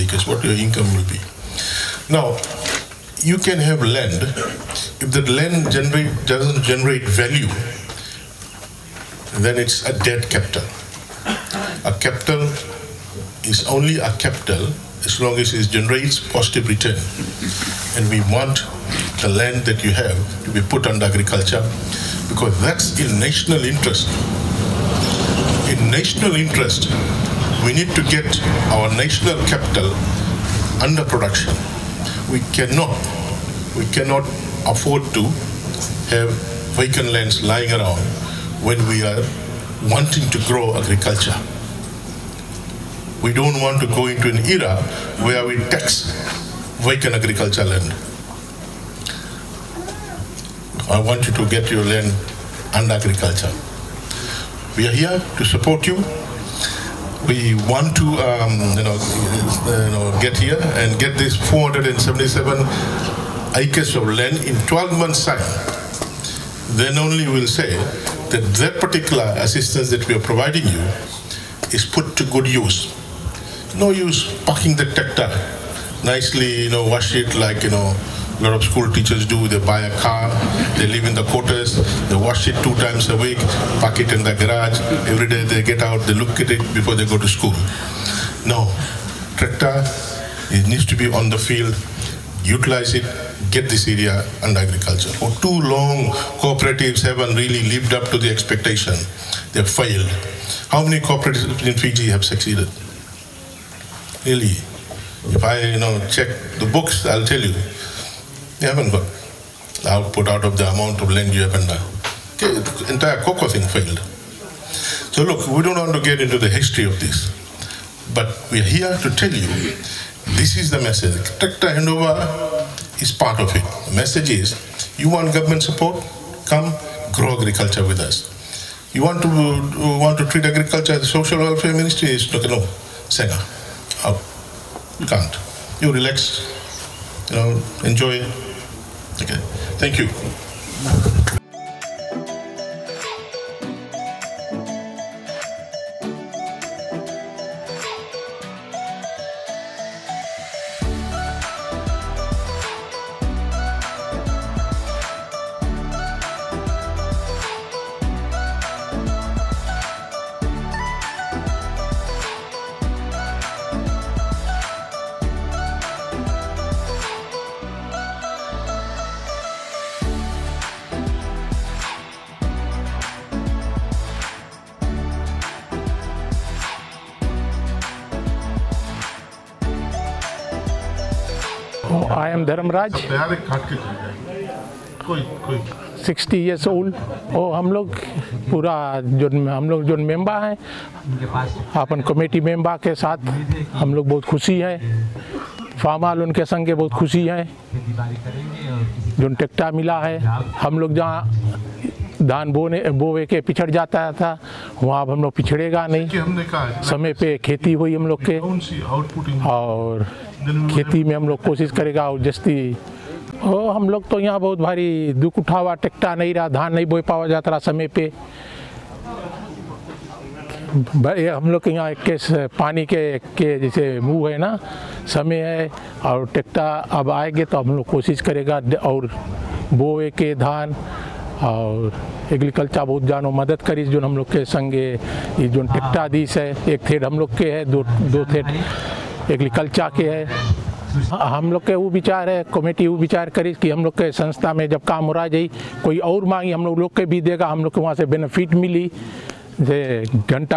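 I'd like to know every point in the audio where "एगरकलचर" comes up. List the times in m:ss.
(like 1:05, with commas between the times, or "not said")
3:52, 3:59.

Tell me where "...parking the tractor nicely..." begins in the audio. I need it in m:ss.
1:14.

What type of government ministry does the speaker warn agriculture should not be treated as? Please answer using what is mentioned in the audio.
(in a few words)
social welfare ministry.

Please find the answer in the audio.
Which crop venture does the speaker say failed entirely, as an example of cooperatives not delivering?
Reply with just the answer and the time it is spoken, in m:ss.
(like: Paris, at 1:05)
cocoa, at 1:53.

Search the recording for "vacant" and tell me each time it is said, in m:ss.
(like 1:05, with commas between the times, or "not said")
0:36, 0:46.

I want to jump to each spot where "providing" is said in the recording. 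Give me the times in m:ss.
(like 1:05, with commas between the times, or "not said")
1:10.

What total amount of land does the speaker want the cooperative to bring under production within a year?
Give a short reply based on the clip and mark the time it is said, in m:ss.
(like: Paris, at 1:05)
477 acres, at 1:01.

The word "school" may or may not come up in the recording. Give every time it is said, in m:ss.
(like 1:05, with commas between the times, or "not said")
1:18, 1:27.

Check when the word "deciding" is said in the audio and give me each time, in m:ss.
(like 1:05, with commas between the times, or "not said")
not said.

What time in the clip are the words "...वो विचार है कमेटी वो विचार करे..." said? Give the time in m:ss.
4:01.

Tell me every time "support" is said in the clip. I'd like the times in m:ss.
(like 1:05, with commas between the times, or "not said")
0:55, 2:05.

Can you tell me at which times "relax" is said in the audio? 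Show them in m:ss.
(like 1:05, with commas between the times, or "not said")
2:15.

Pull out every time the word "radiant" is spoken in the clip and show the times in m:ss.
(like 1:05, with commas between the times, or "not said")
not said.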